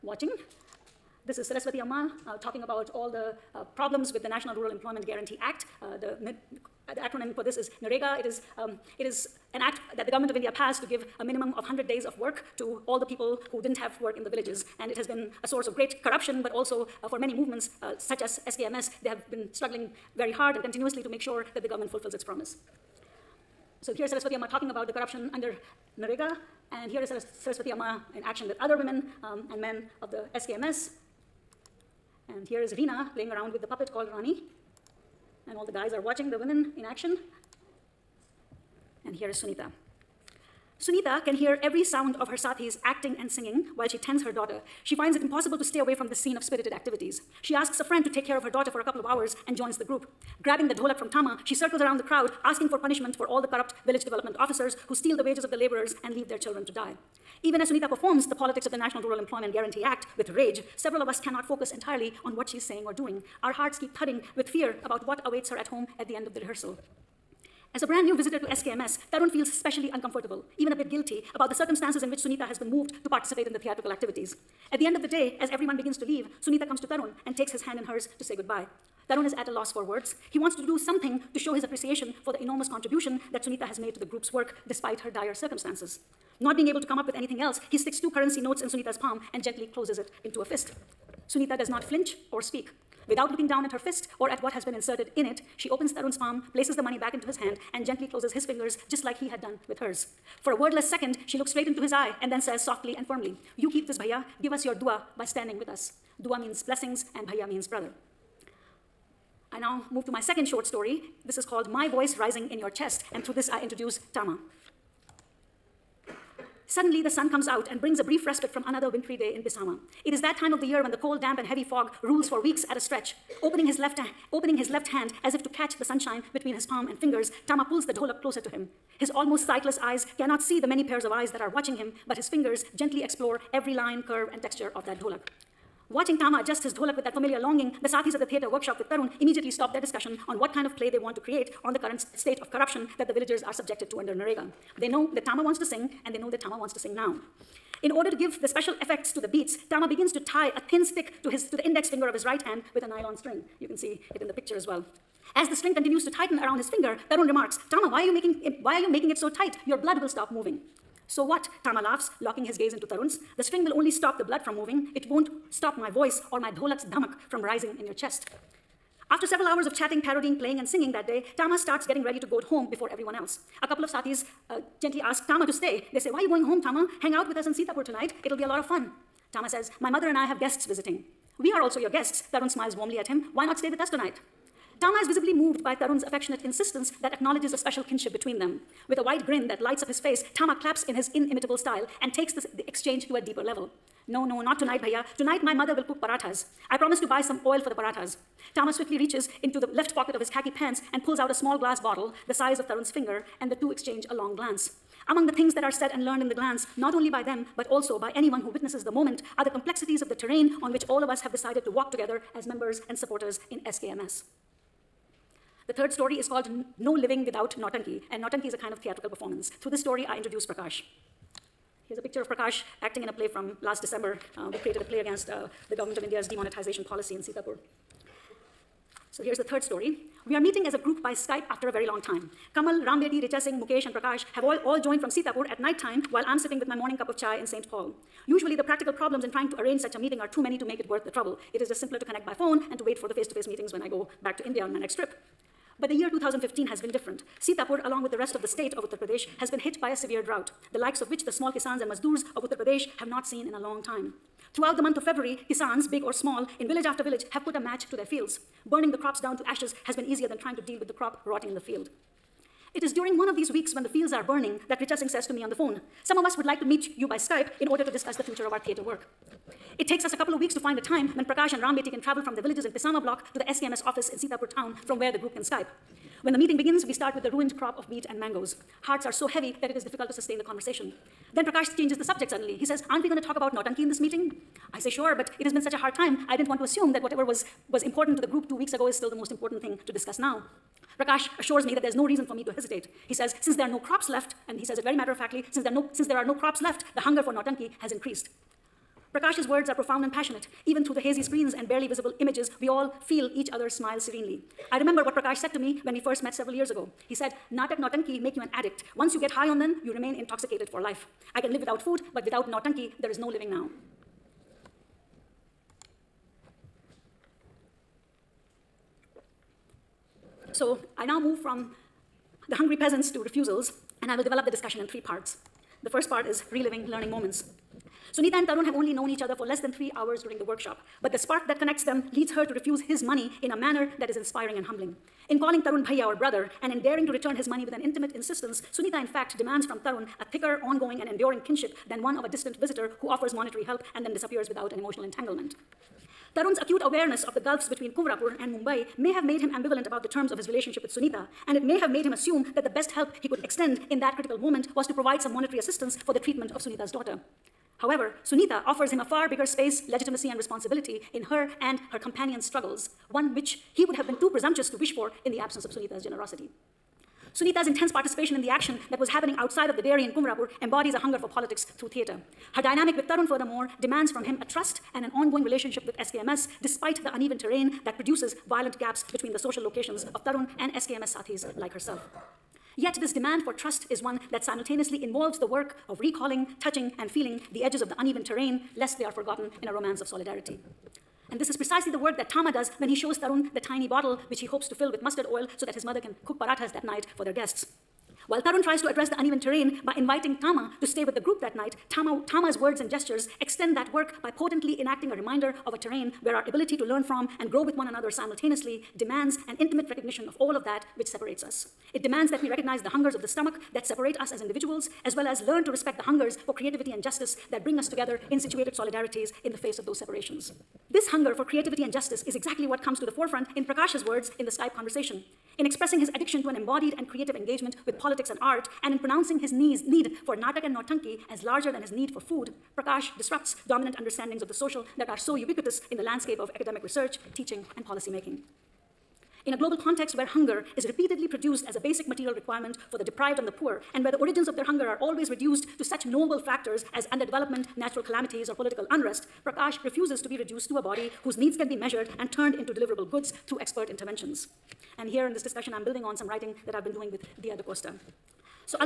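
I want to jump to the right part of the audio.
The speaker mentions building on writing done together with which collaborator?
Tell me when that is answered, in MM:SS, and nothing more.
07:37.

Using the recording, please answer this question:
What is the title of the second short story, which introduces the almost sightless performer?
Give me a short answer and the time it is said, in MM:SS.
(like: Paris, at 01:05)
My Voice Rising in Your Chest, at 01:51.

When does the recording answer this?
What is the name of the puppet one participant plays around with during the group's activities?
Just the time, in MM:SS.
00:34.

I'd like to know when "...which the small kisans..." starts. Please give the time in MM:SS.
04:11.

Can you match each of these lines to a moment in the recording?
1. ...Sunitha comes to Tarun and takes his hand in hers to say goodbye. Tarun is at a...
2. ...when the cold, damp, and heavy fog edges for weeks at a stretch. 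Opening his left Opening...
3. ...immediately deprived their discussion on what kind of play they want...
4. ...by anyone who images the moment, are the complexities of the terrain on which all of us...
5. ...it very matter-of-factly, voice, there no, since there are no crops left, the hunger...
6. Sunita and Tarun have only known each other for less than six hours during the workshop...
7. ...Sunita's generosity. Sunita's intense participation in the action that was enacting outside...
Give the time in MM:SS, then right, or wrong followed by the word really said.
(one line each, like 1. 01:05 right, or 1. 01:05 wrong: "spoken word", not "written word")
1. 01:16 right
2. 02:00 wrong: "rules", not "edges"
3. 02:19 wrong: "stopped", not "deprived"
4. 03:27 wrong: "witnesses", not "images"
5. 04:54 wrong: "since", not "voice"
6. 05:28 wrong: "three", not "six"
7. 06:05 wrong: "happening", not "enacting".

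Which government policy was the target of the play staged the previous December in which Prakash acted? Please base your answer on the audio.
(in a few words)
Demonetization.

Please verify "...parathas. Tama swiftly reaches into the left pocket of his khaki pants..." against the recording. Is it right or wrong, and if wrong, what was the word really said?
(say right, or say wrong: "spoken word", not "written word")
right.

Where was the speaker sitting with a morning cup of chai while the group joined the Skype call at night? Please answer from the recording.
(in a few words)
St. Paul.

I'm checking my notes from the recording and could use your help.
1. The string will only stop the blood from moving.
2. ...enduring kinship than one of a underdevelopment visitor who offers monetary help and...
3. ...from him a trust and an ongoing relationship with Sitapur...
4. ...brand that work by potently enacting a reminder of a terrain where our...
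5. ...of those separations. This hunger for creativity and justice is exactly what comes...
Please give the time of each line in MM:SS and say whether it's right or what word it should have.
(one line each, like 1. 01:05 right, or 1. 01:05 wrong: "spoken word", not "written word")
1. 02:43 right
2. 05:41 wrong: "distant", not "underdevelopment"
3. 06:14 wrong: "SKMS", not "Sitapur"
4. 06:43 wrong: "extend", not "brand"
5. 06:59 right.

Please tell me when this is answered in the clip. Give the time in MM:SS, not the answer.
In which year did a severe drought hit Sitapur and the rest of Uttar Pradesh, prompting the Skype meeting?
04:06.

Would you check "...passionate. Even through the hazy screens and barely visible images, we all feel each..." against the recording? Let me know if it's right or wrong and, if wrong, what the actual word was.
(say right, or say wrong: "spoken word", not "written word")
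right.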